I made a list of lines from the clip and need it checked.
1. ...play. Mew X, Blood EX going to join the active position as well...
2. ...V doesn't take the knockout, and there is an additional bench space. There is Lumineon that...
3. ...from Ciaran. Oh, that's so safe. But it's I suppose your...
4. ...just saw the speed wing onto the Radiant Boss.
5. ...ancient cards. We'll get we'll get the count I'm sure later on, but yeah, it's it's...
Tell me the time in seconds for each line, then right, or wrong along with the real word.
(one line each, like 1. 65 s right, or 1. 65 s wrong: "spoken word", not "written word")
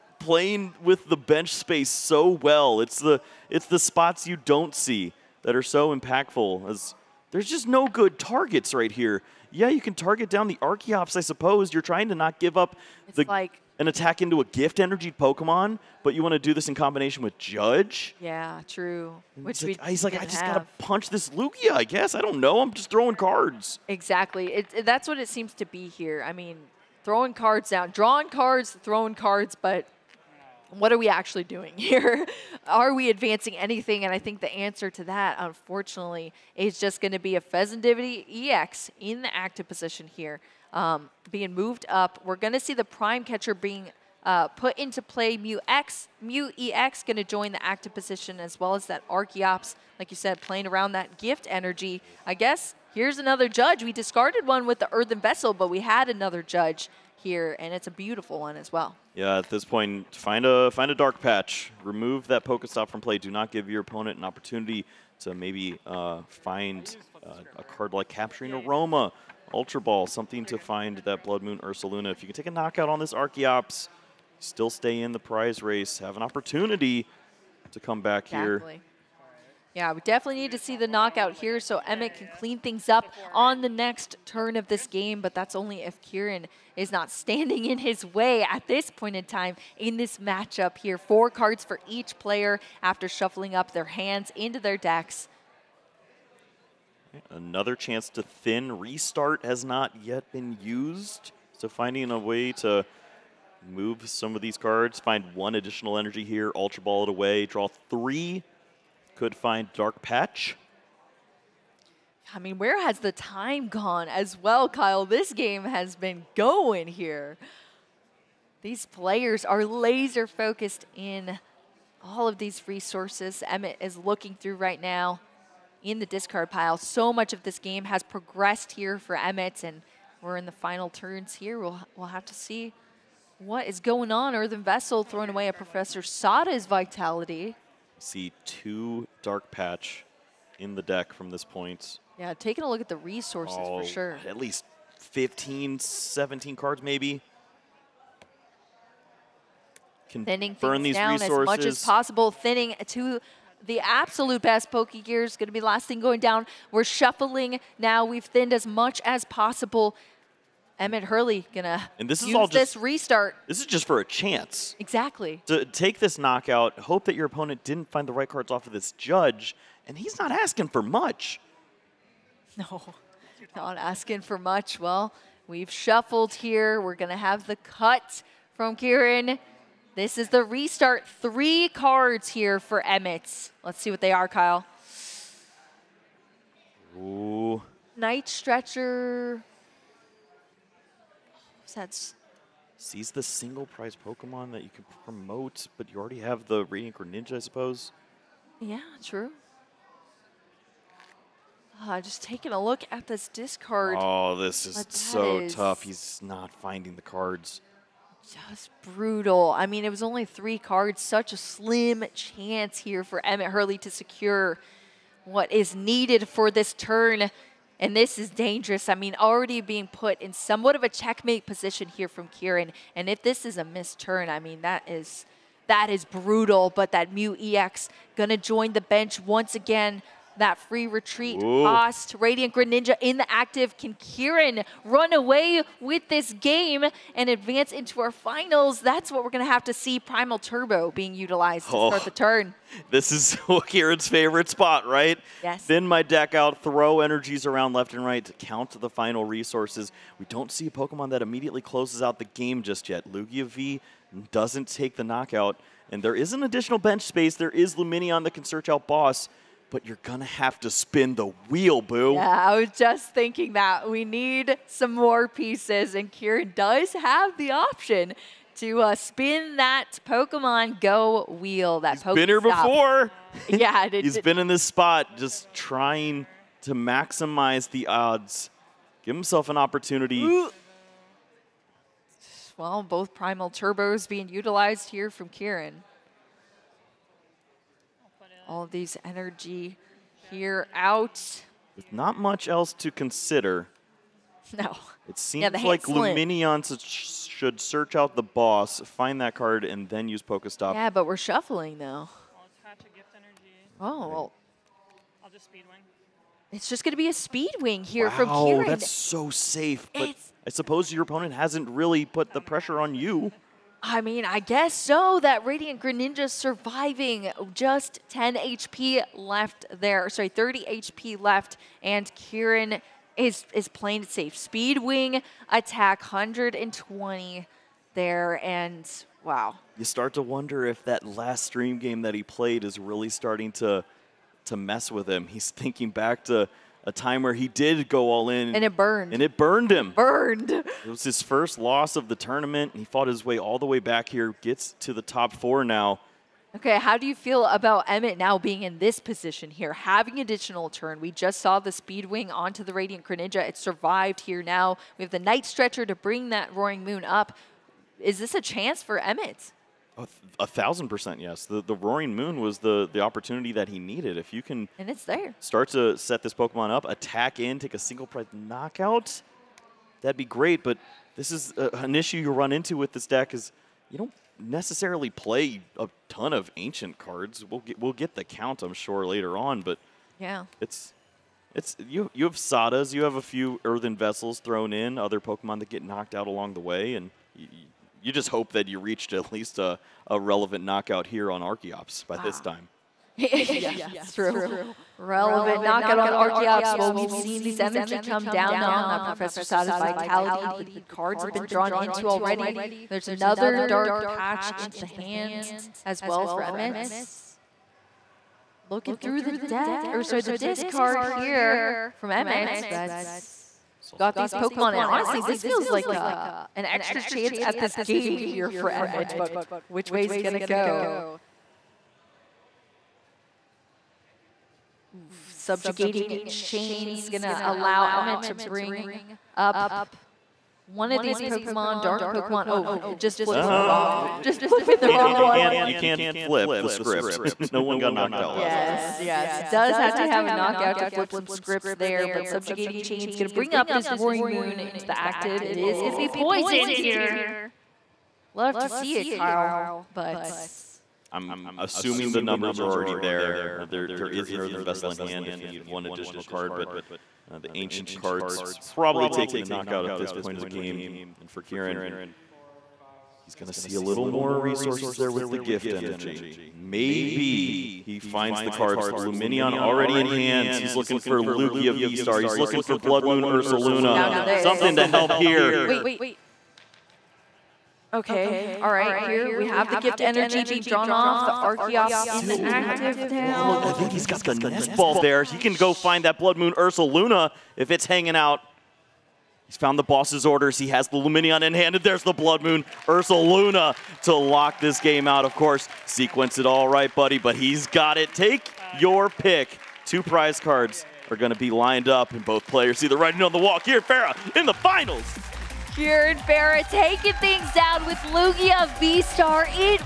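1. 45 s wrong: "Mew", not "Blood"
2. 253 s right
3. 308 s right
4. 351 s wrong: "Greninja", not "Boss"
5. 376 s right.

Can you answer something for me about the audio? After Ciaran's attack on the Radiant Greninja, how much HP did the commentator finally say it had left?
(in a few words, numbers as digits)
30 HP.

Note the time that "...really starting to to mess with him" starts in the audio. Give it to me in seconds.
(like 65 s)
332 s.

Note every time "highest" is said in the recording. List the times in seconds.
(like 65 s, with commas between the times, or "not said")
not said.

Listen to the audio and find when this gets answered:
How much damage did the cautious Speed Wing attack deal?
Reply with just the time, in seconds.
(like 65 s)
326 s.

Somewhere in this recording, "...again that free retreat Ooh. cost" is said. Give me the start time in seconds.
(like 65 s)
229 s.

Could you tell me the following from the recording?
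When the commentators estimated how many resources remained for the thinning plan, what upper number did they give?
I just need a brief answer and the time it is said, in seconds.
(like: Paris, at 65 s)
17, at 145 s.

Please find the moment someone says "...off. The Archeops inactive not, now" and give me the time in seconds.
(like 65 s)
480 s.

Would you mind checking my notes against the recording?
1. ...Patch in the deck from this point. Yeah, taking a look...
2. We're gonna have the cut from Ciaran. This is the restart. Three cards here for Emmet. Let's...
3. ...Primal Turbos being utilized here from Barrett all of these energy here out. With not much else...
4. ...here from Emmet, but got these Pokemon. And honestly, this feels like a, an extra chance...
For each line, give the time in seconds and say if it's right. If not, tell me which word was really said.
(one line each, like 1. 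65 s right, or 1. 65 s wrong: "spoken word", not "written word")
1. 139 s right
2. 176 s right
3. 283 s wrong: "Ciaran", not "Barrett"
4. 411 s right.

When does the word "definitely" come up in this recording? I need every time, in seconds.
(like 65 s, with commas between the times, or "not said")
80 s.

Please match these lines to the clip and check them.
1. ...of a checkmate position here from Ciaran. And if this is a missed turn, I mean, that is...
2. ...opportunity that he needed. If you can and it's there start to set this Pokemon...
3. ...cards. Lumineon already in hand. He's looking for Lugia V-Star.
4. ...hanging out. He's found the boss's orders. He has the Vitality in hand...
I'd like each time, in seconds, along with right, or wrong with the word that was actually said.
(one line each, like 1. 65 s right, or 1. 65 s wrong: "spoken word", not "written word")
1. 220 s right
2. 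363 s right
3. 468 s right
4. 487 s wrong: "Lumineon", not "Vitality".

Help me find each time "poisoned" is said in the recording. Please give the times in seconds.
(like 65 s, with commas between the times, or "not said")
446 s.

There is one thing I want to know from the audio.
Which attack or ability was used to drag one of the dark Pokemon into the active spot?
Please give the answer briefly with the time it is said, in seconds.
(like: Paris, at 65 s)
Subjugating Chains, at 425 s.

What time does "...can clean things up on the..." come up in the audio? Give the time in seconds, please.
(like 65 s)
82 s.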